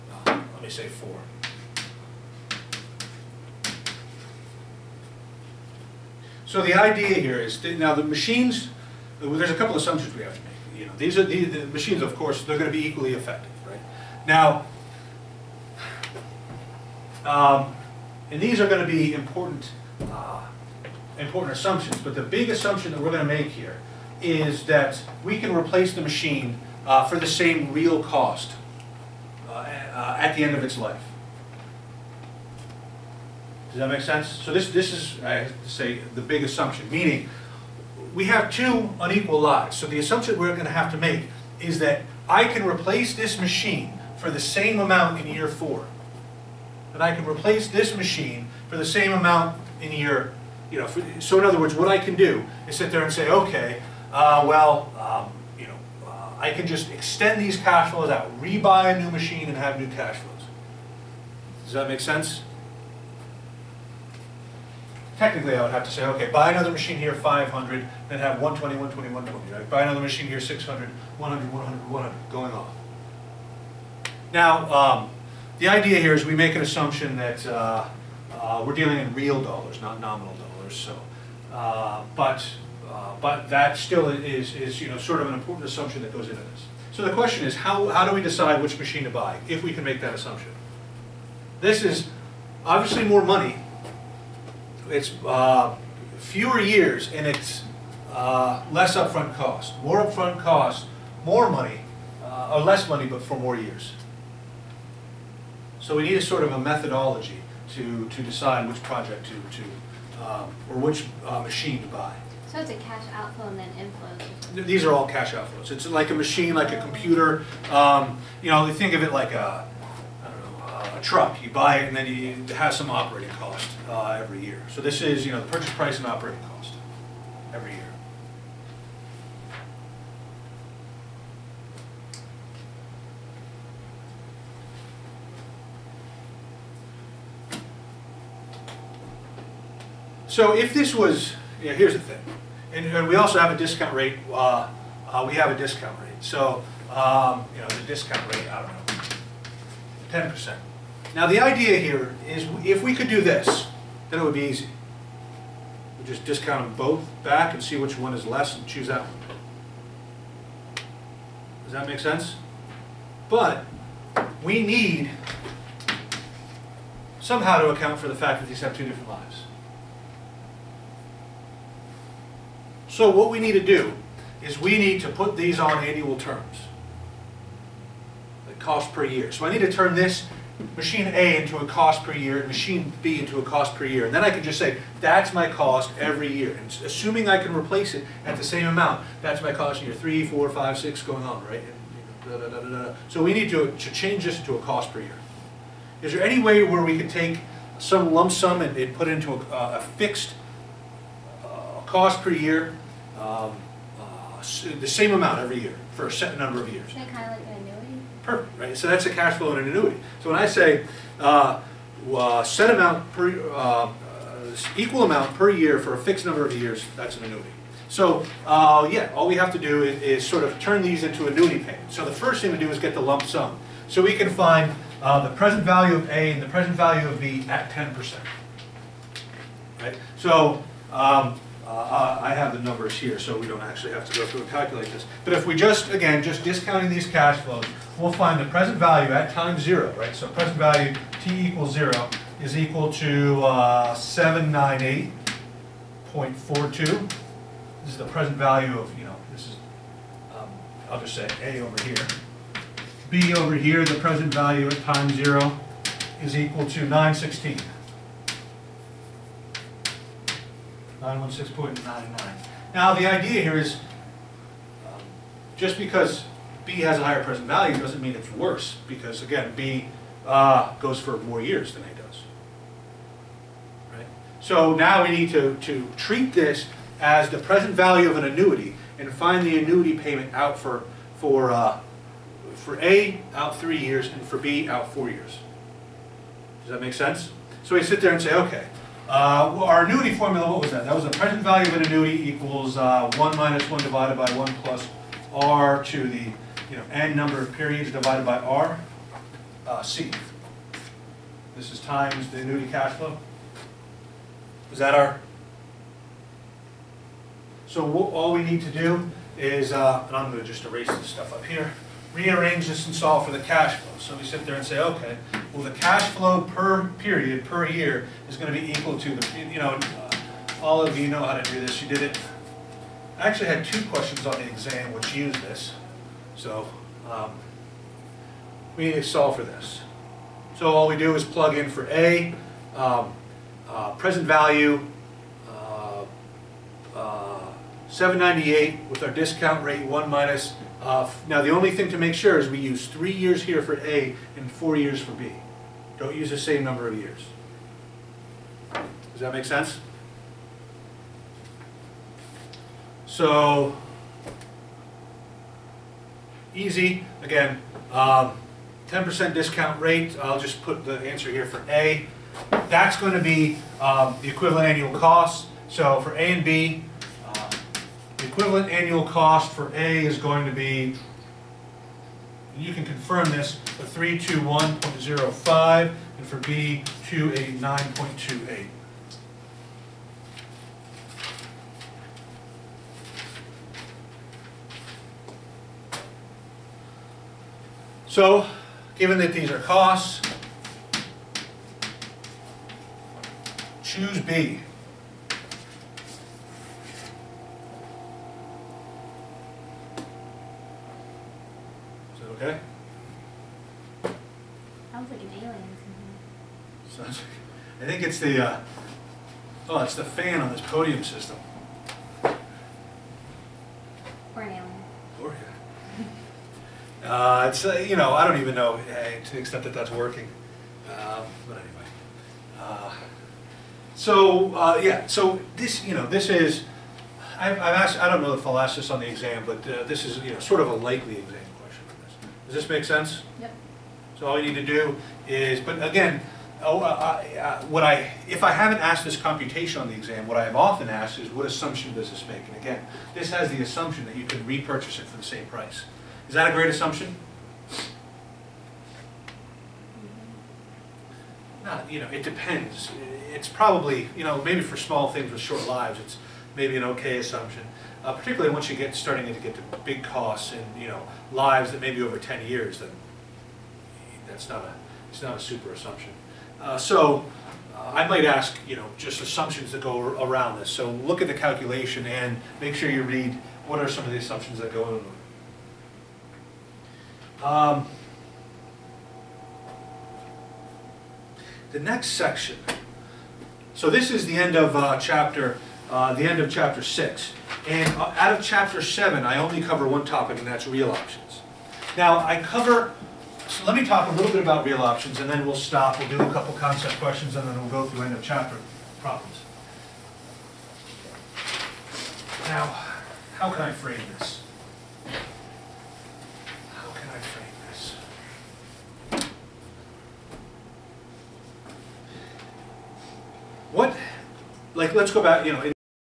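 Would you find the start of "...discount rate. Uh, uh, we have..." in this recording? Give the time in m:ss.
2:23.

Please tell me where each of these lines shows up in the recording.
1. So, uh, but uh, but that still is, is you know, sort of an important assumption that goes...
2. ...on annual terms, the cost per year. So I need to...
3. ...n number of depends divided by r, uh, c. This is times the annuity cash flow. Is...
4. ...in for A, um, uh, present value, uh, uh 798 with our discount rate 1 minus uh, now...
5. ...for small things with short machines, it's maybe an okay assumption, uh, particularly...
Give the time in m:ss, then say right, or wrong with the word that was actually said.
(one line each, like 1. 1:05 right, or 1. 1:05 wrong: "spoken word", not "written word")
1. 1:20 right
2. 2:55 right
3. 4:56 wrong: "periods", not "depends"
4. 5:31 right
5. 7:34 wrong: "lives", not "machines".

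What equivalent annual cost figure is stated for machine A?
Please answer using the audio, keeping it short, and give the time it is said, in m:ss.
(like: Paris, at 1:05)
321.05, at 6:13.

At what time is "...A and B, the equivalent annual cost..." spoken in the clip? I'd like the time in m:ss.
6:06.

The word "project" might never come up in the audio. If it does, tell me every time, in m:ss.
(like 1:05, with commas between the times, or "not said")
1:48.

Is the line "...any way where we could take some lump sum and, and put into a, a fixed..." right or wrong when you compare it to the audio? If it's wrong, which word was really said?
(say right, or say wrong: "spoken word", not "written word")
right.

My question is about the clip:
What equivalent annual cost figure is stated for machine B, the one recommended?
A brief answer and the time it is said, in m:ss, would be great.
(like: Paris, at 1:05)
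289.28, at 6:17.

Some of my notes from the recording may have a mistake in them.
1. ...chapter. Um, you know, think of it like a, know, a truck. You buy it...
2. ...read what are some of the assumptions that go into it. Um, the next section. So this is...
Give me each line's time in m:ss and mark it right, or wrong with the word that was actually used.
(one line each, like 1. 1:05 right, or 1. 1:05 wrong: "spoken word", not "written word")
1. 1:56 wrong: "computer", not "chapter"
2. 7:53 right.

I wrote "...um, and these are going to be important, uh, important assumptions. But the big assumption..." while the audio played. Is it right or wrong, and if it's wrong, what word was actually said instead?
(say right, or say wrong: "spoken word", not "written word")
right.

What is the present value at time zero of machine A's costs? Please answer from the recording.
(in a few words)
798.42.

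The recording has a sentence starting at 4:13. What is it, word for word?
B over here, the present value at time zero is equal to 916.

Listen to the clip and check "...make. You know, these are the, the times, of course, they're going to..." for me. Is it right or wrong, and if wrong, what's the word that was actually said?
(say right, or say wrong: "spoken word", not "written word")
wrong: "machines", not "times".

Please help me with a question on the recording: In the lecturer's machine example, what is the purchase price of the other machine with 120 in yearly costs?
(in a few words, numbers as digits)
500.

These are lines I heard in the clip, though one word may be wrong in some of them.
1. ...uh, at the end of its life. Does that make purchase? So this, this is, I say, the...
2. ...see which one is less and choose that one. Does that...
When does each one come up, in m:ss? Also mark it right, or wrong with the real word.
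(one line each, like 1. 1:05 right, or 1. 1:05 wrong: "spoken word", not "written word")
1. 0:29 wrong: "sense", not "purchase"
2. 2:37 right.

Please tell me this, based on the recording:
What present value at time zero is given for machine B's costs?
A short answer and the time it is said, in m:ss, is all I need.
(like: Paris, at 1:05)
916.99, at 4:21.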